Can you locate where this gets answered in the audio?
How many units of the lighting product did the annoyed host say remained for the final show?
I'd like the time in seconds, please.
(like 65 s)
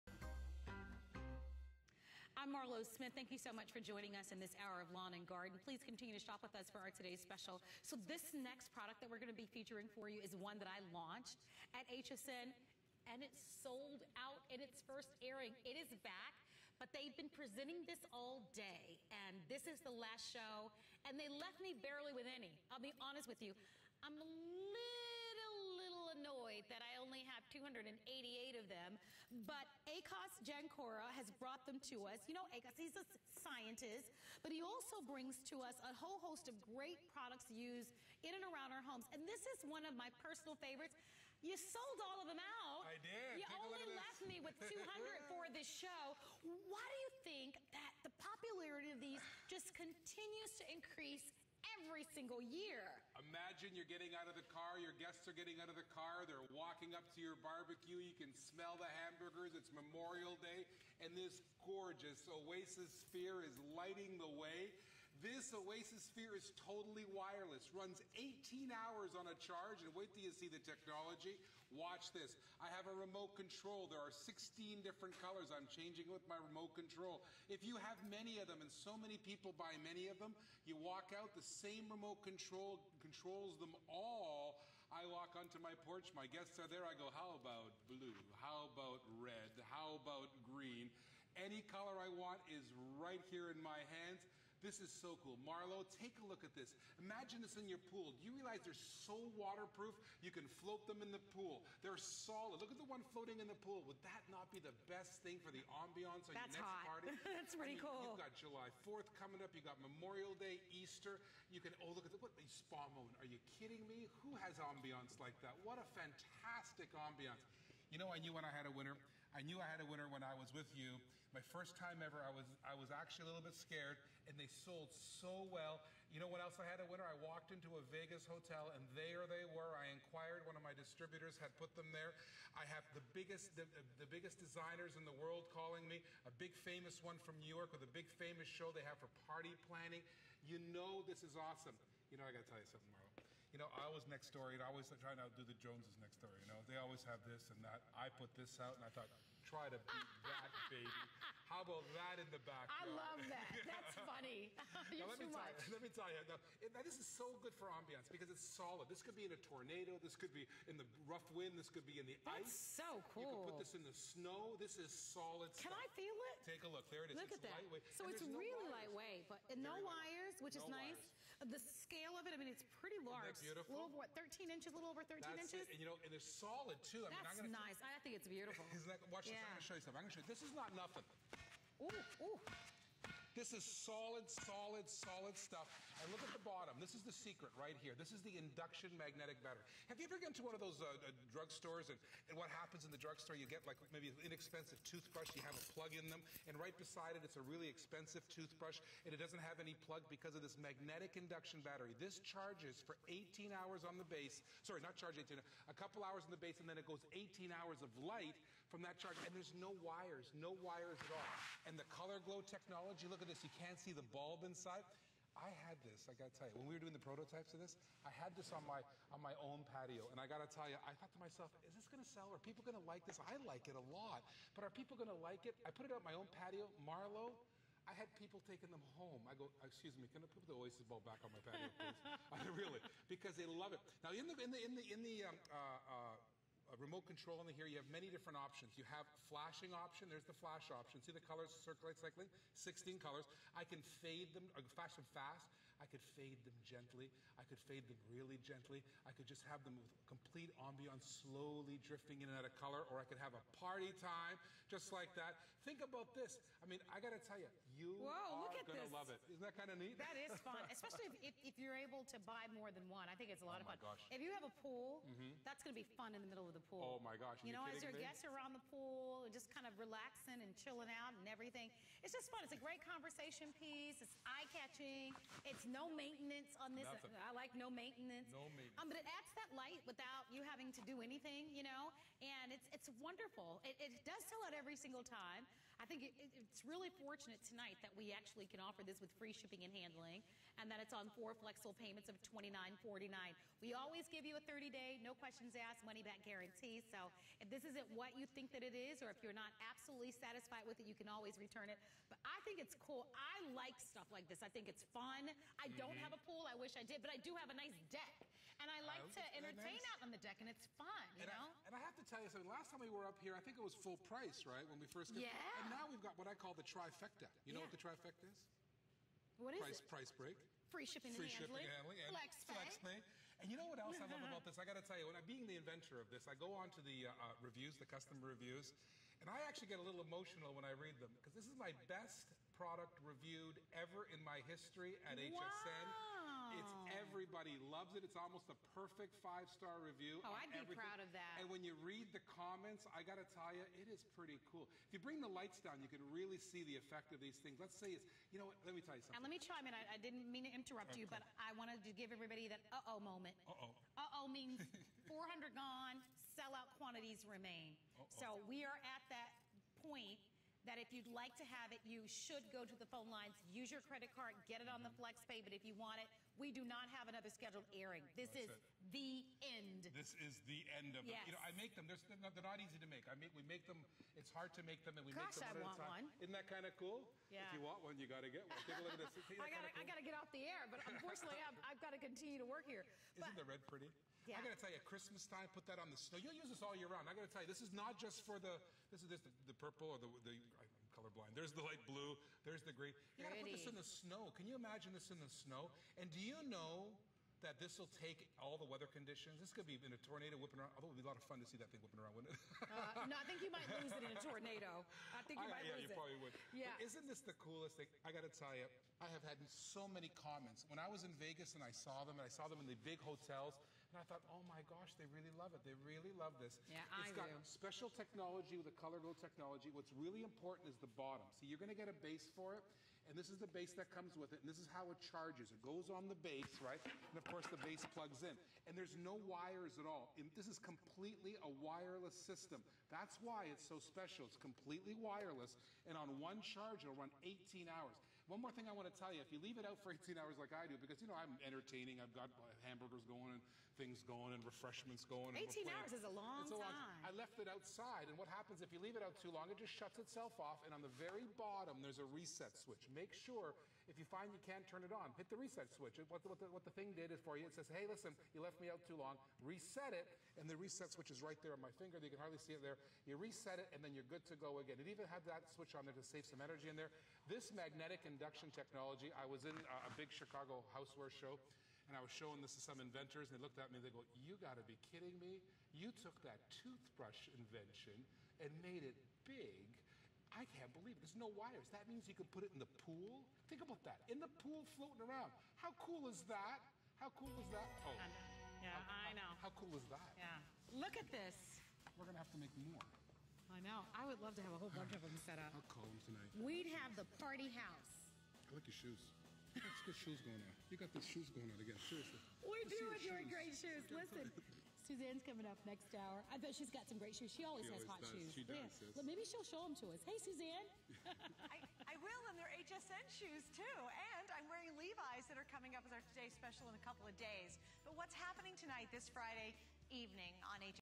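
27 s.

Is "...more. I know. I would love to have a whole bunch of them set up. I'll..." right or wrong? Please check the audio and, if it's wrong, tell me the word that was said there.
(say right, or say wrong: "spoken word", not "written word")
right.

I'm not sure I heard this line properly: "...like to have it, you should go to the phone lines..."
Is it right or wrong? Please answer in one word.
right.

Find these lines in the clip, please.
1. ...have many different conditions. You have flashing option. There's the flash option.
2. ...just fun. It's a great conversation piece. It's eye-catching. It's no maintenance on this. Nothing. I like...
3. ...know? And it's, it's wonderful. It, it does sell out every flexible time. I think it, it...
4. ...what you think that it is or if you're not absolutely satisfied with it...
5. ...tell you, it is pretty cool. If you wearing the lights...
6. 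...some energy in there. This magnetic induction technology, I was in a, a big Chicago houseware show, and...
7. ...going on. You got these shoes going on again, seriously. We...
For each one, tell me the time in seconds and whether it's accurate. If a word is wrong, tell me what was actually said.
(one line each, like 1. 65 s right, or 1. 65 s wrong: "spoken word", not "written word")
1. 237 s wrong: "options", not "conditions"
2. 272 s right
3. 281 s wrong: "single", not "flexible"
4. 297 s right
5. 343 s wrong: "bring", not "wearing"
6. 466 s right
7. 500 s right.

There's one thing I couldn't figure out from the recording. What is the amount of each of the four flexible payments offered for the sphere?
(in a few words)
$29.49.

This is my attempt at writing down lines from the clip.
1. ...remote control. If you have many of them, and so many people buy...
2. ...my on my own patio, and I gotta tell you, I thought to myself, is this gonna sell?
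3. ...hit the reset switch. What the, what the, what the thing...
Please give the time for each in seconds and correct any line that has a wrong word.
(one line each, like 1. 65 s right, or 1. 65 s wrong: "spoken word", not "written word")
1. 76 s right
2. 218 s right
3. 455 s right.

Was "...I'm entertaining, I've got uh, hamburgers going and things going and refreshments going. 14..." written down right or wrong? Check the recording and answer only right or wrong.
wrong.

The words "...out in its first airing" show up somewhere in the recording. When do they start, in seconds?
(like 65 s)
14 s.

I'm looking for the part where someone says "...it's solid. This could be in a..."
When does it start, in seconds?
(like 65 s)
158 s.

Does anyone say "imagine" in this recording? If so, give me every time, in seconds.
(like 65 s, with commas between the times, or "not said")
53 s, 97 s, 394 s.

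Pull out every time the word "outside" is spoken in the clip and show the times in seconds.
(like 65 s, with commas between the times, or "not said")
447 s.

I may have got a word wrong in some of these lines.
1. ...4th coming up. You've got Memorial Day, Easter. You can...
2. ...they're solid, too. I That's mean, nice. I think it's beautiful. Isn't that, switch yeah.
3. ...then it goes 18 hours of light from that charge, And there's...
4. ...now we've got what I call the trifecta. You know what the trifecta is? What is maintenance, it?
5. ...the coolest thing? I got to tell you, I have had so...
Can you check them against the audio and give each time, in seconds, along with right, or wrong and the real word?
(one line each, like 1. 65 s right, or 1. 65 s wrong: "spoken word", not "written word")
1. 108 s right
2. 176 s wrong: "watch", not "switch"
3. 206 s right
4. 315 s wrong: "price", not "maintenance"
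5. 407 s right.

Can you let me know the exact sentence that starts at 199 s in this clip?
And it doesn't have any plug because of this magnetic induction battery.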